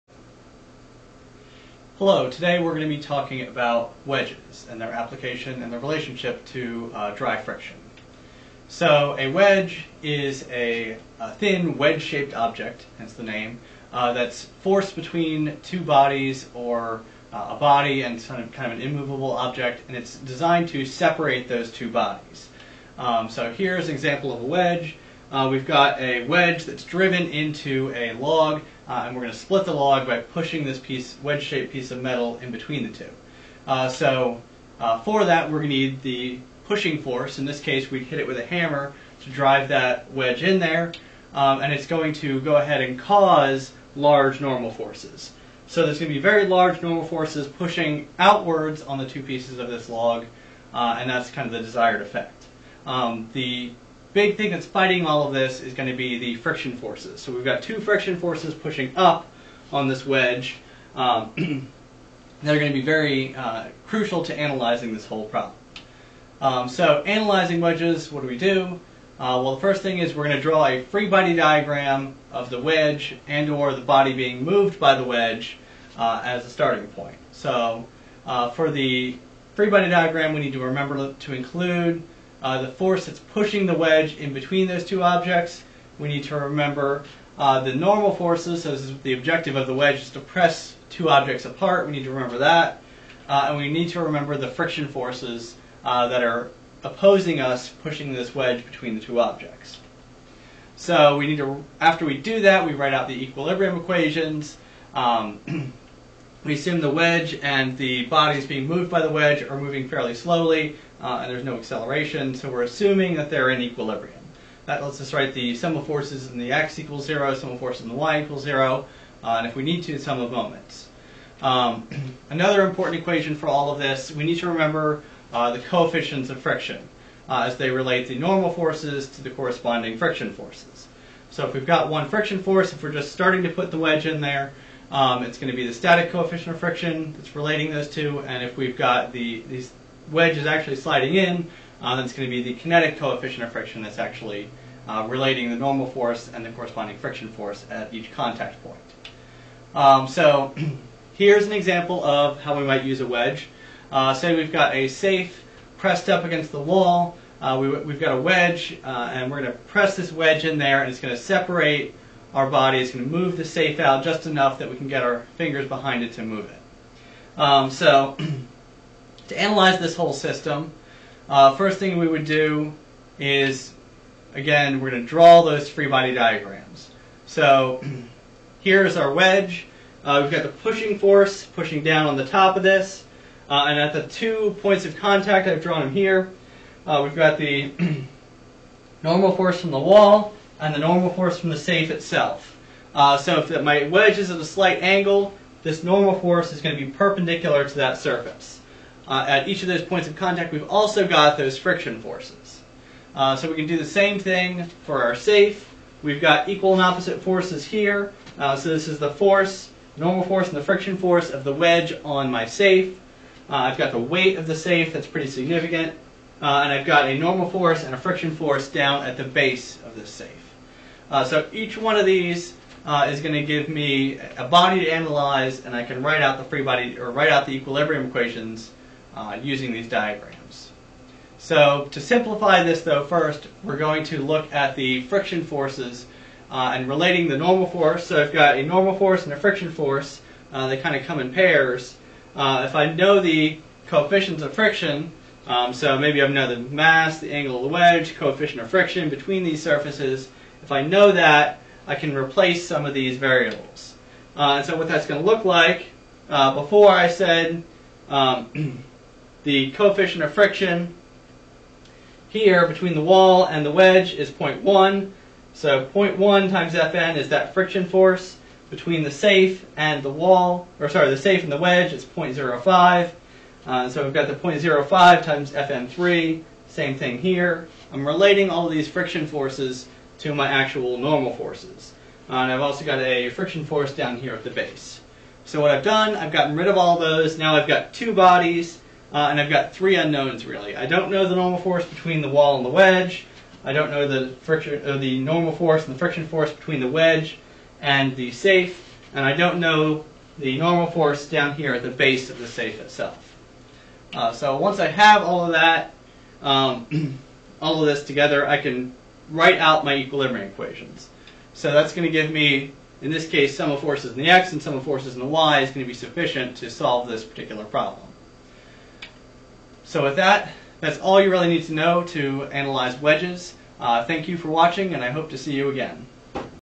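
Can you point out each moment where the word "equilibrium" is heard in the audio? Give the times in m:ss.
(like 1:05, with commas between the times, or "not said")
1:43, 1:53, 3:47, 5:09.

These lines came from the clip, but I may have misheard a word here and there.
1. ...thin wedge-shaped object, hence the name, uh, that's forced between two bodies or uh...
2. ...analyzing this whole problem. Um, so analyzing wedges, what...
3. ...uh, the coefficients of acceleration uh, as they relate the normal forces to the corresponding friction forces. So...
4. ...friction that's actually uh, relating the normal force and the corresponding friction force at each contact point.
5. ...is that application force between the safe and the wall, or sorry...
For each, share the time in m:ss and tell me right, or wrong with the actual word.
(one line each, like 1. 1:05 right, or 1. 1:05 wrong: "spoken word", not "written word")
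1. 0:11 right
2. 1:04 right
3. 2:05 wrong: "friction", not "acceleration"
4. 2:23 right
5. 4:27 wrong: "friction", not "application".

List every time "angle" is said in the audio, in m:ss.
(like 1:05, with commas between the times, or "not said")
3:14, 4:07.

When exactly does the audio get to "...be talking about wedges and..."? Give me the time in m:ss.
0:02.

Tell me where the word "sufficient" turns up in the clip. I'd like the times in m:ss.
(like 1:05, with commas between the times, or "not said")
5:15.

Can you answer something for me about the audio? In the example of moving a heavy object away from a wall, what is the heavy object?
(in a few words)
A safe.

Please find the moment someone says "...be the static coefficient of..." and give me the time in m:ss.
2:15.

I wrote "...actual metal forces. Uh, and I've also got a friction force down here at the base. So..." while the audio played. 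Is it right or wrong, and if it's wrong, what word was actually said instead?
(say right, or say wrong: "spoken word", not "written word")
wrong: "normal", not "metal".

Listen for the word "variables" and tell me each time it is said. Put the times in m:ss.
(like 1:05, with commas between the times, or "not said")
4:13.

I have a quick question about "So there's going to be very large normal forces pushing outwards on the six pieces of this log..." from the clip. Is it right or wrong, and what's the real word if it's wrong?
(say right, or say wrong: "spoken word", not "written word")
wrong: "two", not "six".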